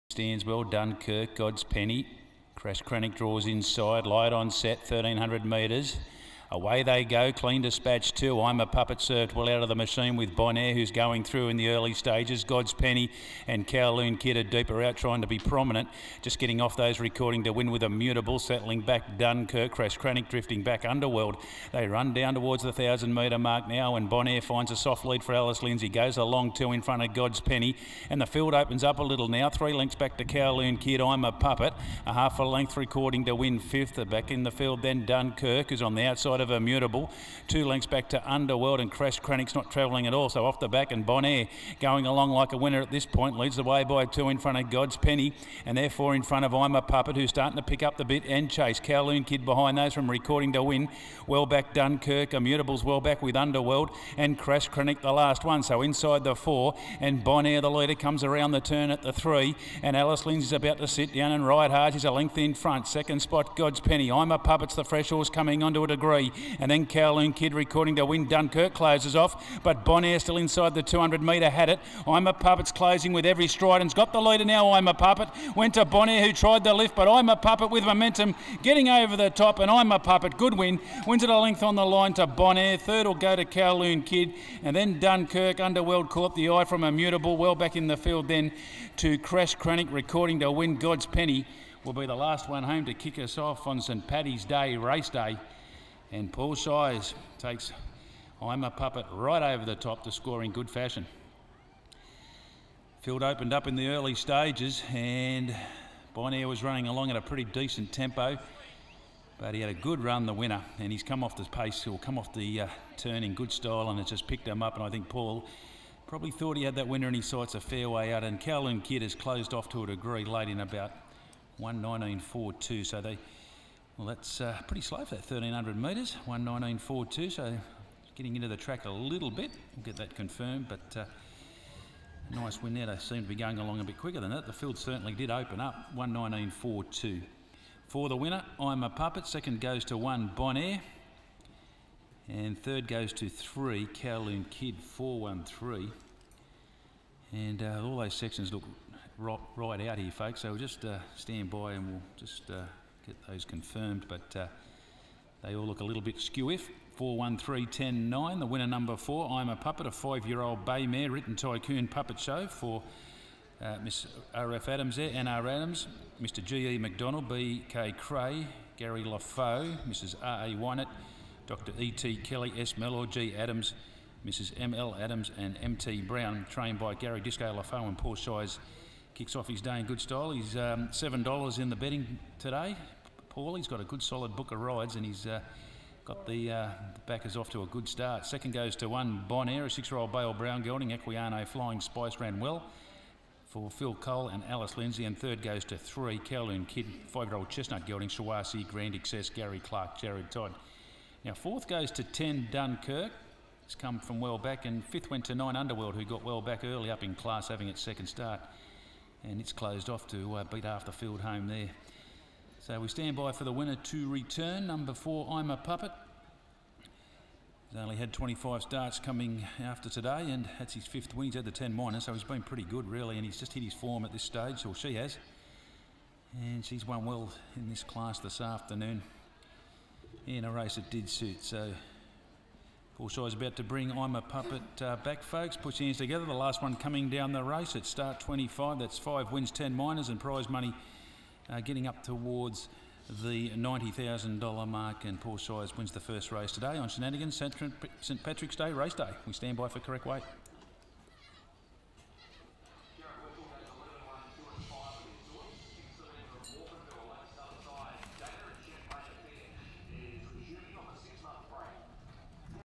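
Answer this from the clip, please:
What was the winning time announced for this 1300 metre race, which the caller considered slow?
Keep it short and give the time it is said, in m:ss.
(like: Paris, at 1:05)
119.42, at 2:00.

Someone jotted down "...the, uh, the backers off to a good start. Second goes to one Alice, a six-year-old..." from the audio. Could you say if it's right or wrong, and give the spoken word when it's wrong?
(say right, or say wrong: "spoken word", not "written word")
wrong: "Bonaire", not "Alice".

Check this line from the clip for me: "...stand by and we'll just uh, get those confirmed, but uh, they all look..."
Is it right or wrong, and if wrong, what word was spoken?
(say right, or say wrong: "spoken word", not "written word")
right.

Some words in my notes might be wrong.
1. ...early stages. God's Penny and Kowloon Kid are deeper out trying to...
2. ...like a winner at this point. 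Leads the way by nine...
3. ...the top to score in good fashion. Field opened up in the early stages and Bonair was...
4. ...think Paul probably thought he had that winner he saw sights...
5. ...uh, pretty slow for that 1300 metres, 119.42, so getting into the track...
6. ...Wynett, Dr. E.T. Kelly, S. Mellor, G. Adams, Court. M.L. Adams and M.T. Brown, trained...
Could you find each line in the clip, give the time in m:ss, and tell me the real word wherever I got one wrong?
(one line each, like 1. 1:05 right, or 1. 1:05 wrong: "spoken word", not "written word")
1. 0:11 right
2. 0:42 wrong: "two", not "nine"
3. 1:39 right
4. 1:54 right
5. 2:04 right
6. 2:50 wrong: "Mrs", not "Court".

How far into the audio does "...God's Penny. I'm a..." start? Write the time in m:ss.
1:03.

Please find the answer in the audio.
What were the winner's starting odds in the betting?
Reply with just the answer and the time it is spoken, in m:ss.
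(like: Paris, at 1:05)
$7, at 3:00.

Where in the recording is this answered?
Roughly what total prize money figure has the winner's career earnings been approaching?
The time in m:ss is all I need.
4:03.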